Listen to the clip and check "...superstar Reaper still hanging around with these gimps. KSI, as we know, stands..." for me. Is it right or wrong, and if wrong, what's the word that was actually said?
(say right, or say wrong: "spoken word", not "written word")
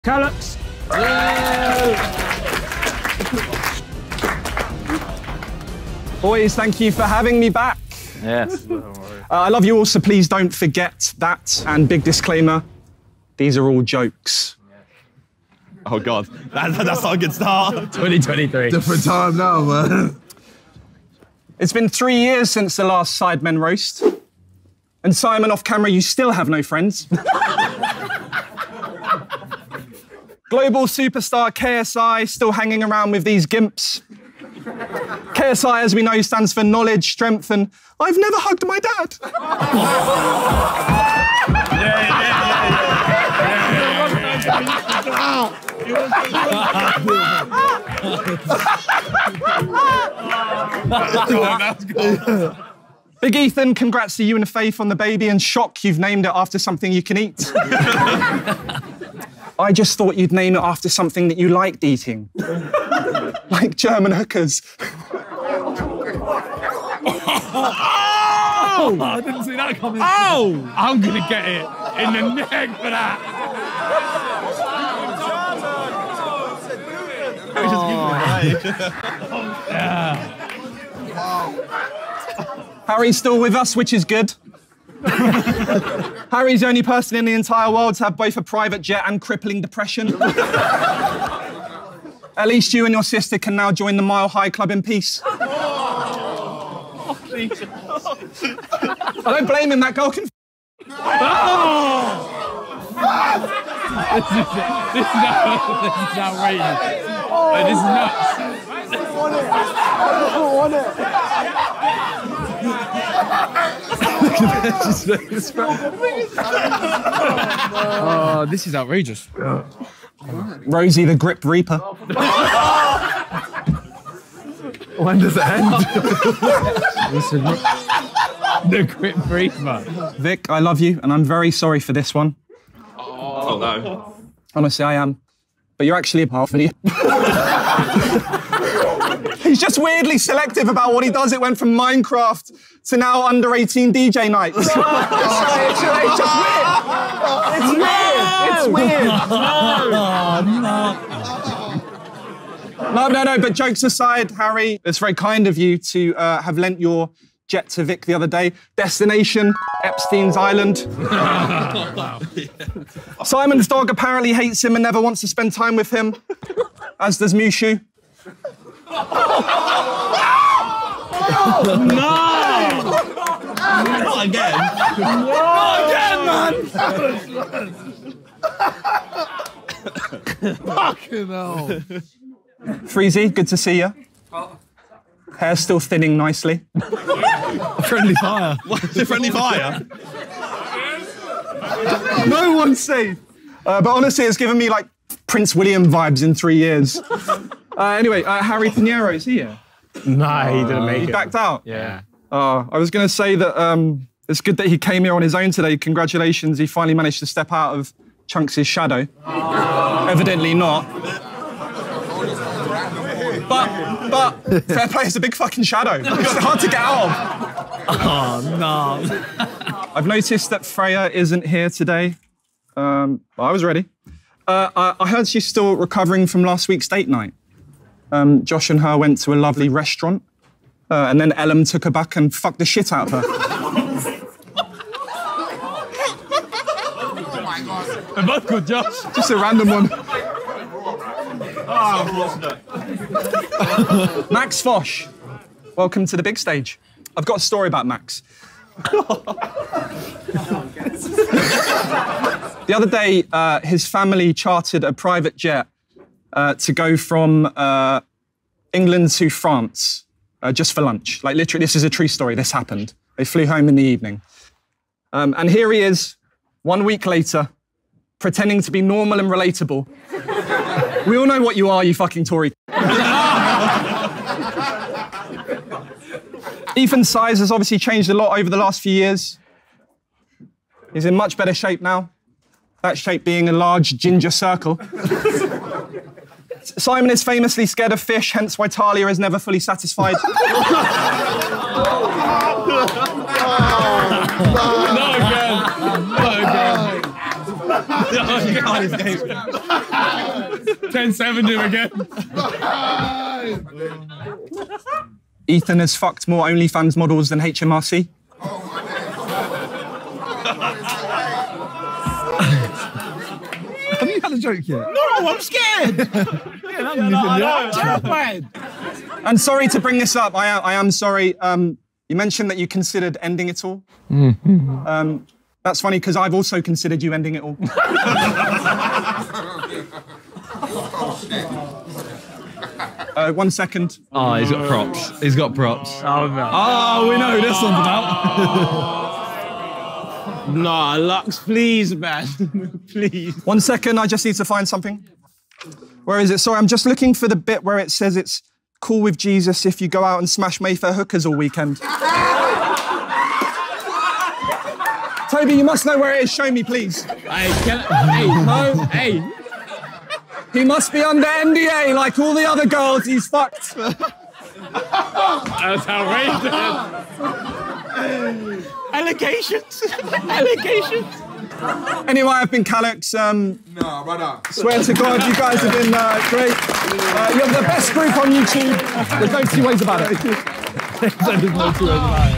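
wrong: "KSI", not "Reaper".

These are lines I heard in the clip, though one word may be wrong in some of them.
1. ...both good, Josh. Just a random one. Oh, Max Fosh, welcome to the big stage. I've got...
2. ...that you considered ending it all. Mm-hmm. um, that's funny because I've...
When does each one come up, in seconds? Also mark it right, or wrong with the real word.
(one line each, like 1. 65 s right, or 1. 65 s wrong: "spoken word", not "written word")
1. 238 s right
2. 322 s right.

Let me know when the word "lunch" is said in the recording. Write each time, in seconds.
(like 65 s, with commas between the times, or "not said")
260 s.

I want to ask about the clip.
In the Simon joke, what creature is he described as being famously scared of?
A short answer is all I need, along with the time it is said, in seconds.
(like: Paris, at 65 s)
Fish, at 288 s.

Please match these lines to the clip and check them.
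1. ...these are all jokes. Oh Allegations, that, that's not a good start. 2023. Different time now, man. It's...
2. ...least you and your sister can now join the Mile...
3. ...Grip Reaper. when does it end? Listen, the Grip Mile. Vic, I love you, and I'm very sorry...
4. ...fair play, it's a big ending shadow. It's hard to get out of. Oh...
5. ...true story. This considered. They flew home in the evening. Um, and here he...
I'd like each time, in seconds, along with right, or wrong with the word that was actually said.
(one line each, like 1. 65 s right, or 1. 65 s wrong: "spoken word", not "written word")
1. 13 s wrong: "God", not "Allegations"
2. 92 s right
3. 121 s wrong: "Reaper", not "Mile"
4. 214 s wrong: "fucking", not "ending"
5. 261 s wrong: "happened", not "considered".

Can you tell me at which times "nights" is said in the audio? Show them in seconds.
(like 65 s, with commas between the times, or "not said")
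144 s, 227 s.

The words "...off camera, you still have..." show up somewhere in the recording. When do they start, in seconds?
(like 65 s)
25 s.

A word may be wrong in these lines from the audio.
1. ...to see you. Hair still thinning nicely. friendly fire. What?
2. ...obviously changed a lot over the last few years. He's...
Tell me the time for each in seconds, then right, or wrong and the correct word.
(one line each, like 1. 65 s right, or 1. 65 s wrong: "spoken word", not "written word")
1. 183 s right
2. 277 s right.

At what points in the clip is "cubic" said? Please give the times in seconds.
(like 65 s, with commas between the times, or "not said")
not said.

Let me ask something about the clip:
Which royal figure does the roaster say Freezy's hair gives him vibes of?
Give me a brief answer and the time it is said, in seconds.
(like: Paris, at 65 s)
Prince William, at 195 s.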